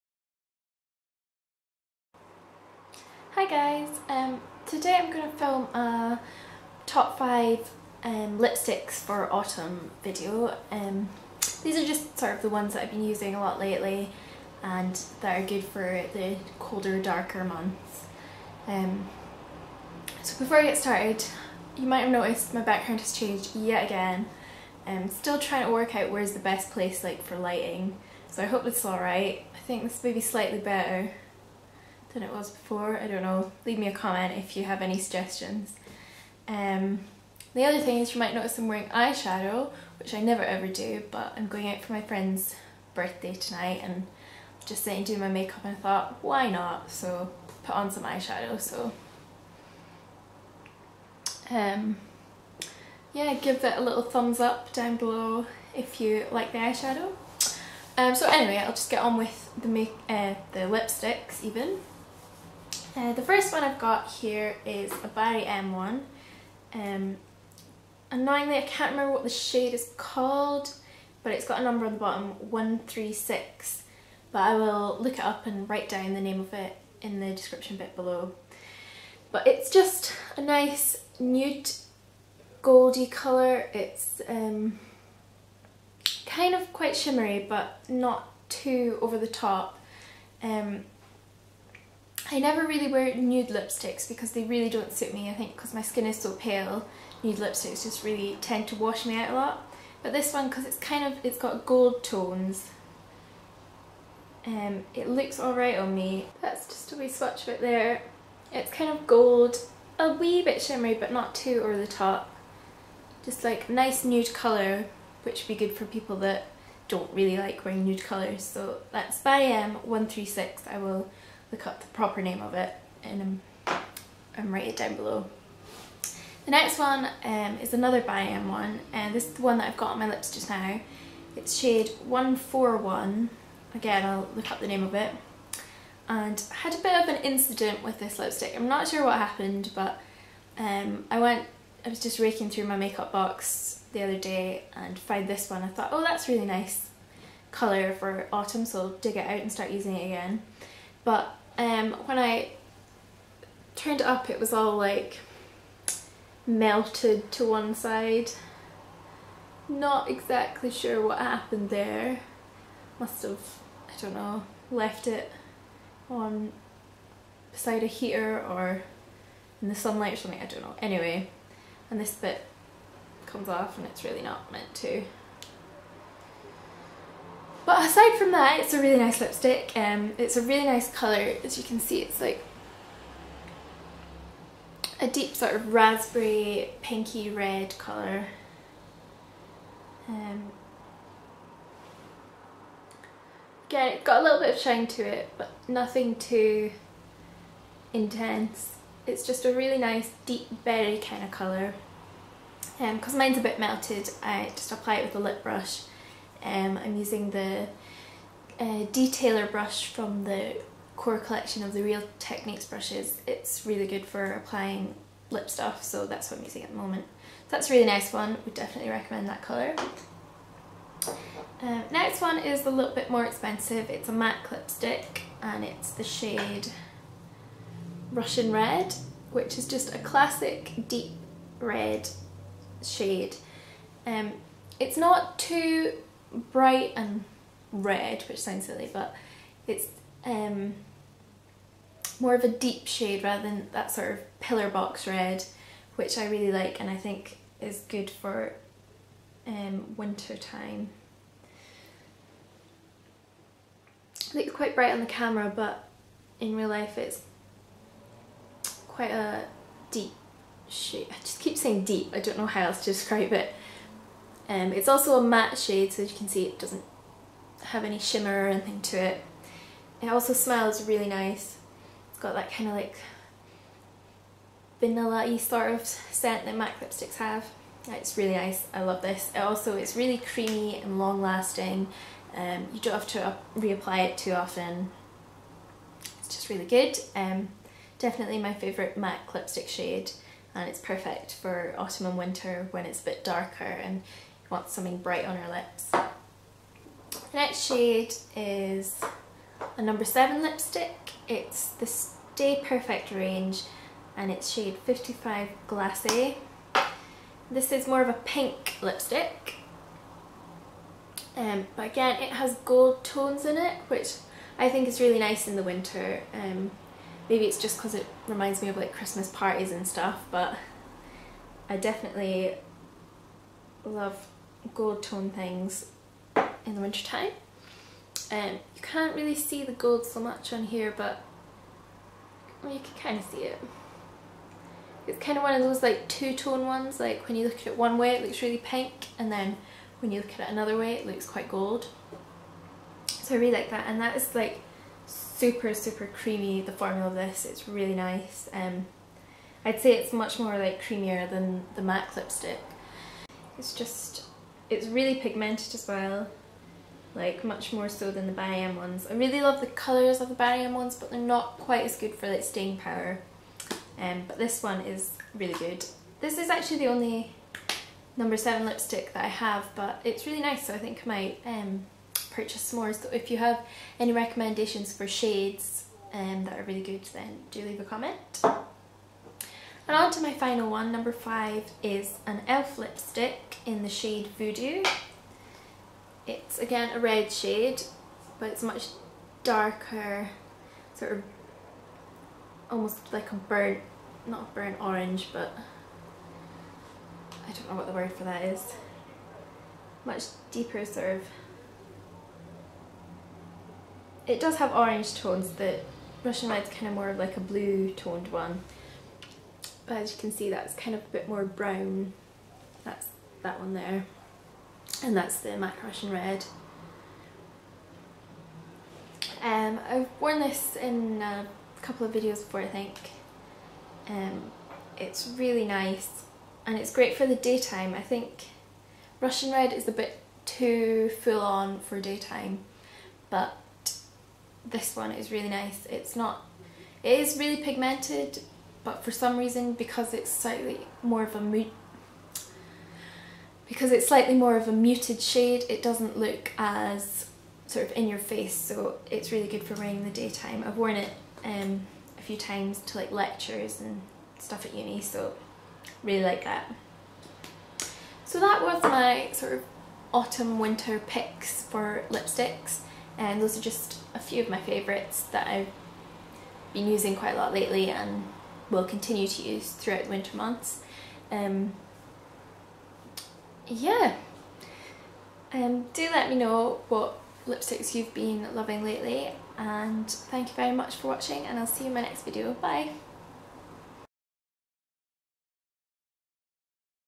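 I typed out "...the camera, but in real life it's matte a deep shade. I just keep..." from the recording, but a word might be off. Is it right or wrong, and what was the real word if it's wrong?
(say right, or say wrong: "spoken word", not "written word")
wrong: "quite", not "matte".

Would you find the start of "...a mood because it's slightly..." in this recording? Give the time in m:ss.
7:21.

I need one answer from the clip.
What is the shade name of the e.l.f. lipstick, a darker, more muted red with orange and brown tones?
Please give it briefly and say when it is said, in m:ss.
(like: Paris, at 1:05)
Voodoo, at 6:24.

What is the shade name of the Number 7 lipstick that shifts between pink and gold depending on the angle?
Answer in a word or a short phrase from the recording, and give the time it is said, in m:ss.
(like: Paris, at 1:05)
Glace, at 5:05.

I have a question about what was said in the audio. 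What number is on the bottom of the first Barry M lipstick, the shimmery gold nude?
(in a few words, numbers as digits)
136.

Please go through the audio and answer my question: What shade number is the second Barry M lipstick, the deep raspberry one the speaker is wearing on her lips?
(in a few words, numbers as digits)
141.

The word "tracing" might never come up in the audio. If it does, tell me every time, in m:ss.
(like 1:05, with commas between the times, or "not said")
not said.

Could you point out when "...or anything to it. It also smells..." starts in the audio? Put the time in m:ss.
4:28.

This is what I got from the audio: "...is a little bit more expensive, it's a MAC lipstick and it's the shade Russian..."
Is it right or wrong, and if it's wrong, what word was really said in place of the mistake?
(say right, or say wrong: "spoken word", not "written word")
right.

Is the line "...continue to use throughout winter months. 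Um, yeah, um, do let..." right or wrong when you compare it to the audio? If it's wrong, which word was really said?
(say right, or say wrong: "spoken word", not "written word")
right.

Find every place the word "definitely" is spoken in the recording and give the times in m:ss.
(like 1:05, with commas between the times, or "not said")
3:38, 4:47, 5:21.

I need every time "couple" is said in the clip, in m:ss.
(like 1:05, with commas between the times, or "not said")
7:01.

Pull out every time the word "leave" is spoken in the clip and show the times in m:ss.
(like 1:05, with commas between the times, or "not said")
0:33, 6:17.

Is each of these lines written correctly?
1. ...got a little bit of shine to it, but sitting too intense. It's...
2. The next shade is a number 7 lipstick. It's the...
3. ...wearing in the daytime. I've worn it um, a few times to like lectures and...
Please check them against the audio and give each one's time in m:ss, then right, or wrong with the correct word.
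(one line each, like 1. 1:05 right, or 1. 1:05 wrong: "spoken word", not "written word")
1. 3:14 wrong: "nothing", not "sitting"
2. 4:57 right
3. 7:29 right.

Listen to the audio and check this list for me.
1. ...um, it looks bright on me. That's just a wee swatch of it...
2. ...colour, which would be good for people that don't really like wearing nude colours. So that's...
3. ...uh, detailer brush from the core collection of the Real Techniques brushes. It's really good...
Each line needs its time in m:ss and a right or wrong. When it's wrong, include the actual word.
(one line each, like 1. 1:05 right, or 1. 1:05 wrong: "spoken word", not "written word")
1. 1:44 wrong: "alright", not "bright"
2. 1:54 right
3. 3:28 right.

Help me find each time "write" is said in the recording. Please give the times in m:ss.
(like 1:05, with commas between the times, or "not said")
1:15, 2:04.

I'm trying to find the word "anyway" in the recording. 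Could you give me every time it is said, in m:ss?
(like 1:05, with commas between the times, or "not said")
0:58, 2:50.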